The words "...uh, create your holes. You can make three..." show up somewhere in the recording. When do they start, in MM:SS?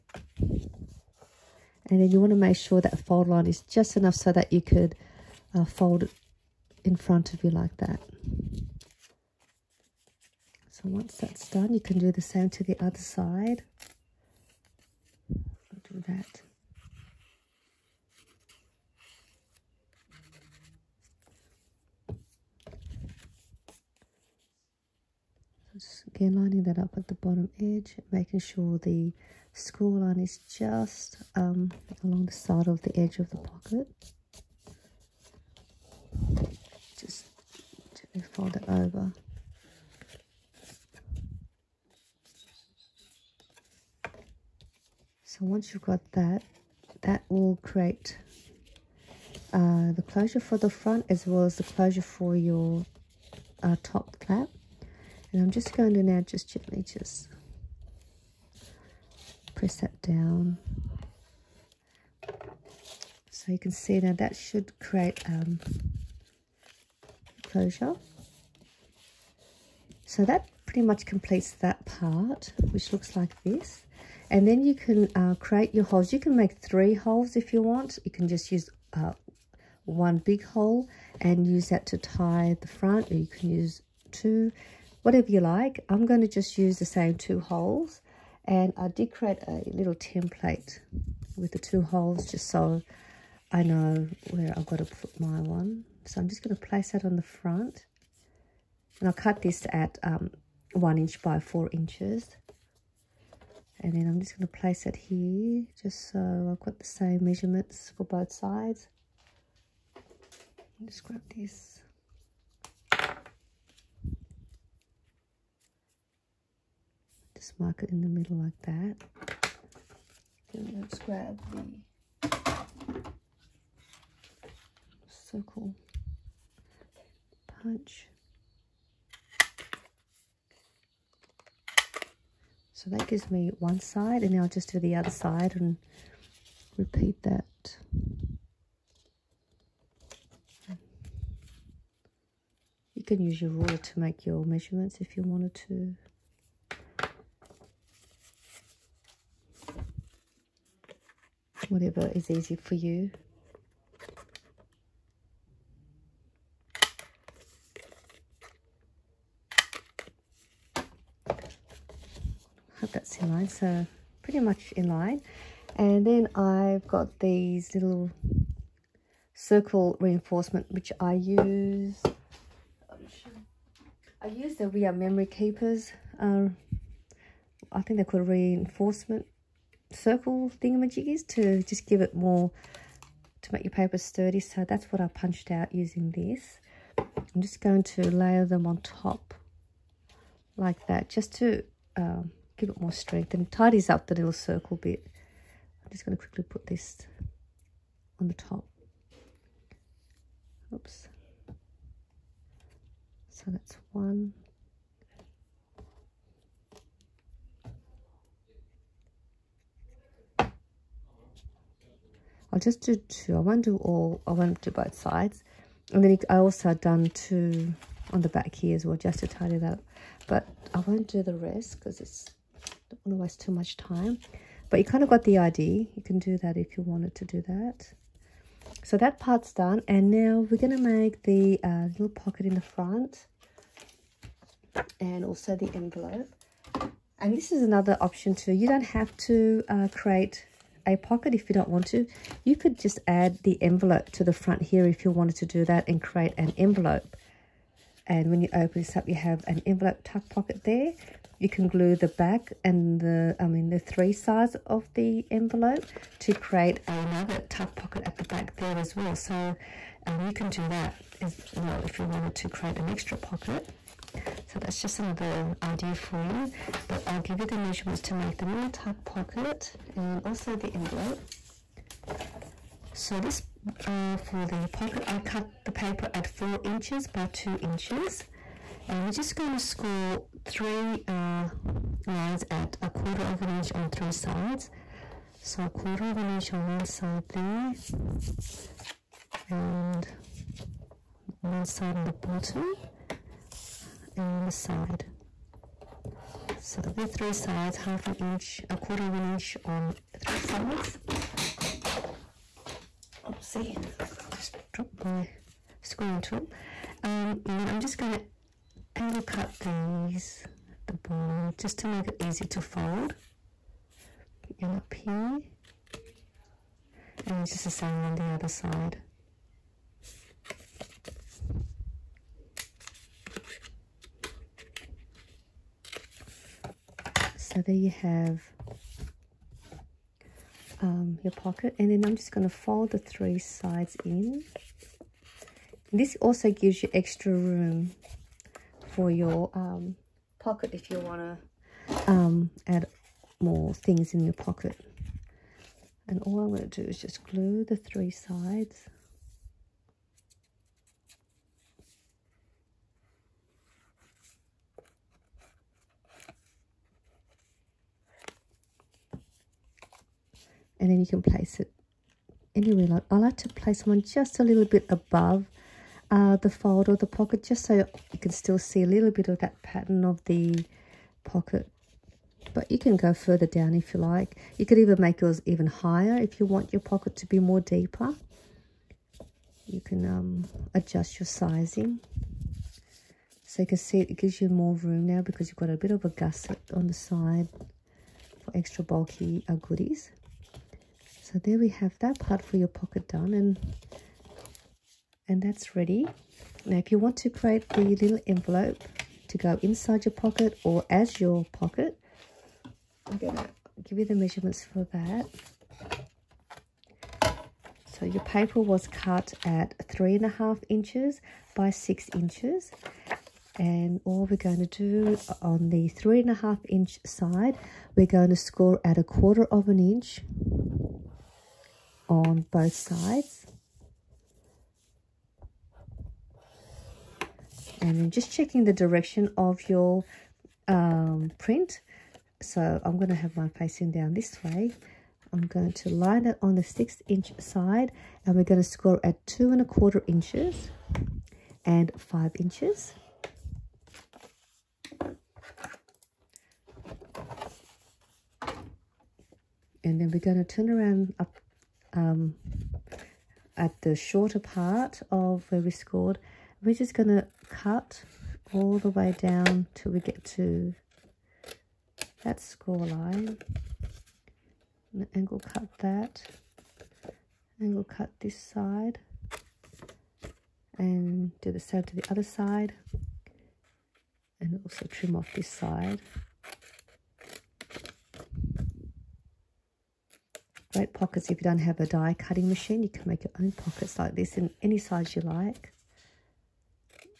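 01:15.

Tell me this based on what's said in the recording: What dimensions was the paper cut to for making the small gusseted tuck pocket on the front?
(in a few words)
4 inches by 2 inches.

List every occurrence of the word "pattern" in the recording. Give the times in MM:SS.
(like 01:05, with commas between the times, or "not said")
06:09.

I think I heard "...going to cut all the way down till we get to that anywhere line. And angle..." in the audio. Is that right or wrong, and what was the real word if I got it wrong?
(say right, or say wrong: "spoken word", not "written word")
wrong: "score", not "anywhere".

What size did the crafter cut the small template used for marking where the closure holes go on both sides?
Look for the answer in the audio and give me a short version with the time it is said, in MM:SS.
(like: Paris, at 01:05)
1 inch by 4 inches, at 01:40.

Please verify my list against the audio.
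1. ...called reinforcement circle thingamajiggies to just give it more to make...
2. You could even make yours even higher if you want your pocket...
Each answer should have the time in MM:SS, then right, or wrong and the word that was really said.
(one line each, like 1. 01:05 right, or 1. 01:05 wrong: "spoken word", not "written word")
1. 02:58 right
2. 06:14 right.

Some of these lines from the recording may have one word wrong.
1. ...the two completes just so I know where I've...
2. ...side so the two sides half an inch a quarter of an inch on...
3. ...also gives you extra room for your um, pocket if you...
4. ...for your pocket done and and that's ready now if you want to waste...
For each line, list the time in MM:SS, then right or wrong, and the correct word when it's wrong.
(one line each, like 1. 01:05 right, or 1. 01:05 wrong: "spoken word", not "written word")
1. 01:31 wrong: "holes", not "completes"
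2. 04:54 wrong: "three", not "two"
3. 05:36 right
4. 06:32 wrong: "create", not "waste".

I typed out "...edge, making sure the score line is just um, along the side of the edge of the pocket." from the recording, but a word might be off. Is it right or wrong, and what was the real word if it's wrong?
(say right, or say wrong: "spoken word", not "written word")
right.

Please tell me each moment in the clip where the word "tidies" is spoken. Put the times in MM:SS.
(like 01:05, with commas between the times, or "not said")
03:13.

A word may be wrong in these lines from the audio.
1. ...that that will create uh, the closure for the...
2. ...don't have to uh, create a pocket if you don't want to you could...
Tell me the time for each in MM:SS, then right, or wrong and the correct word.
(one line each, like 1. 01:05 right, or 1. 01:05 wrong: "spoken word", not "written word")
1. 00:46 right
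2. 03:58 right.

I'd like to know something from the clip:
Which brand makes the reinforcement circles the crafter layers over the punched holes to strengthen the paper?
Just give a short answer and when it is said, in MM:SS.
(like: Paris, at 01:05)
We Are Memory Keepers, at 02:54.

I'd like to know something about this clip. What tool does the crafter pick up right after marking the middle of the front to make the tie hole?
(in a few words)
circle punch.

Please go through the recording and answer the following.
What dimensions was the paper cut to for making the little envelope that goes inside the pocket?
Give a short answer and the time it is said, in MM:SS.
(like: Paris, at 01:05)
3.5 inches by 6 inches, at 06:49.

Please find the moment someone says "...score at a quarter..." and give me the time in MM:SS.
06:58.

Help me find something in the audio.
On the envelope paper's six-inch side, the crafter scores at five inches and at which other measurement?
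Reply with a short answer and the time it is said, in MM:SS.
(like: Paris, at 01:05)
2.25 inches, at 07:19.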